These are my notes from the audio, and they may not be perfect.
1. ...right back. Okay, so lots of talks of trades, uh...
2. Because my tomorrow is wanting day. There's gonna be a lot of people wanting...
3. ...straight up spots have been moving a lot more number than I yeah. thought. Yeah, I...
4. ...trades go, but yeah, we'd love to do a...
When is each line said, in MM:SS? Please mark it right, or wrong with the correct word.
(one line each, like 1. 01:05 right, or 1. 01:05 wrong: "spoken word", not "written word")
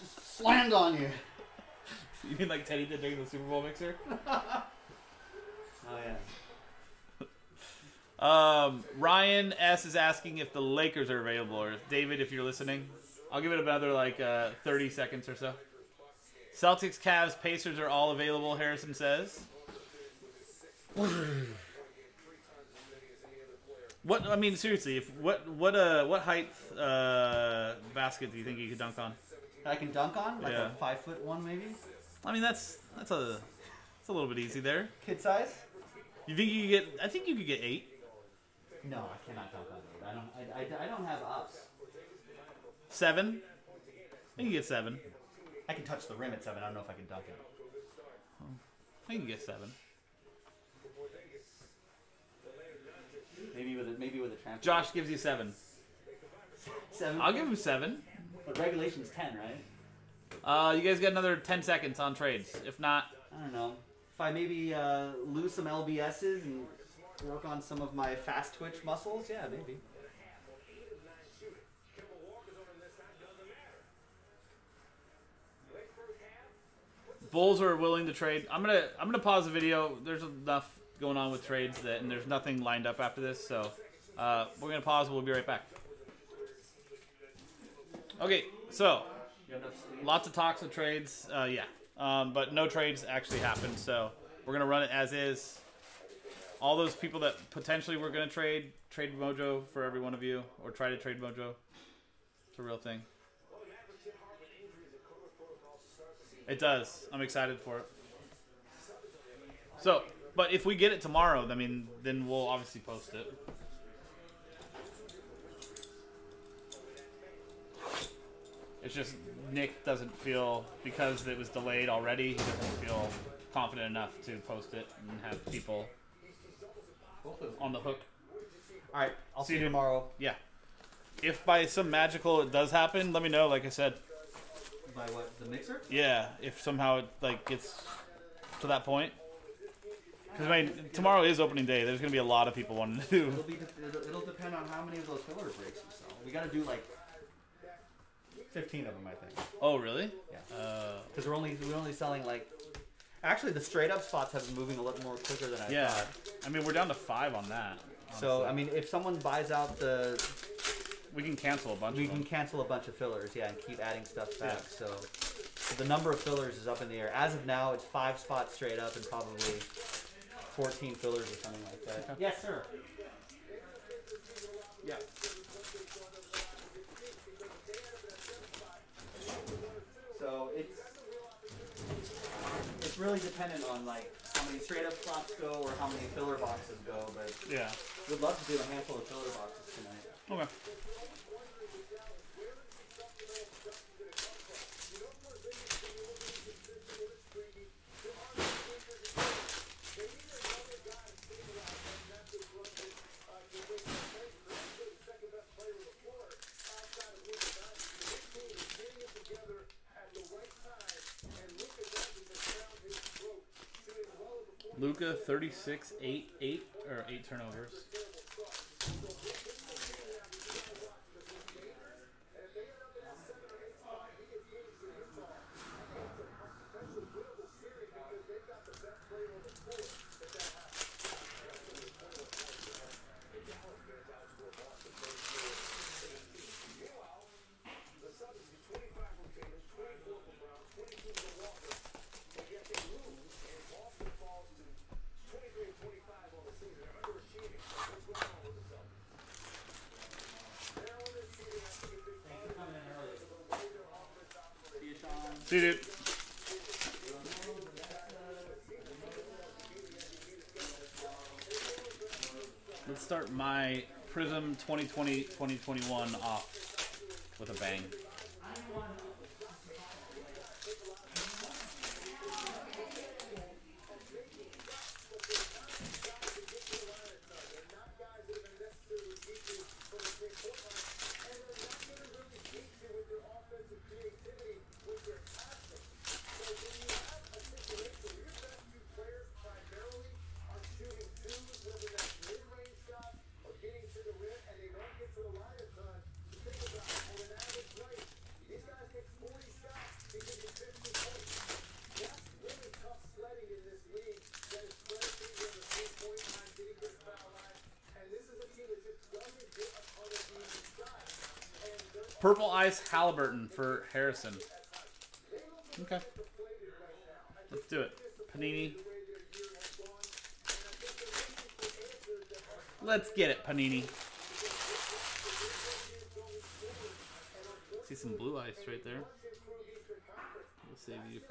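1. 01:25 right
2. 02:20 wrong: "opening", not "wanting"
3. 02:33 wrong: "quicker", not "number"
4. 03:06 wrong: "boxes", not "trades".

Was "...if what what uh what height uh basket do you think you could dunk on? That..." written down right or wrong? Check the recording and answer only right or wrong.
right.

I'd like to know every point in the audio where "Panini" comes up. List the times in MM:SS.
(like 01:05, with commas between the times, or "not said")
05:18, 05:23.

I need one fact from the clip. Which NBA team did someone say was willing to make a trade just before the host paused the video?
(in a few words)
Bulls.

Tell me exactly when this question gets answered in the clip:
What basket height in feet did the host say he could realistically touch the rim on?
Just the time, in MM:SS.
00:45.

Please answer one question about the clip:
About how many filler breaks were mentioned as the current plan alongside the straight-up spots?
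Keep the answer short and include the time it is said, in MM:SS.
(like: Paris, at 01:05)
14, at 02:50.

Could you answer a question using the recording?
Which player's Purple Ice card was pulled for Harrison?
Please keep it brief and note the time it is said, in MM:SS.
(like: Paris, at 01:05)
Halliburton, at 05:12.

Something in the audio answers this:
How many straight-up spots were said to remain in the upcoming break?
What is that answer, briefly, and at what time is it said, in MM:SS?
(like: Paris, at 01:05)
5, at 02:47.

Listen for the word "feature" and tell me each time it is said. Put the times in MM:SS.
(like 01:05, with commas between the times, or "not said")
not said.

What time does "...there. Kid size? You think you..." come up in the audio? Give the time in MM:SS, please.
00:34.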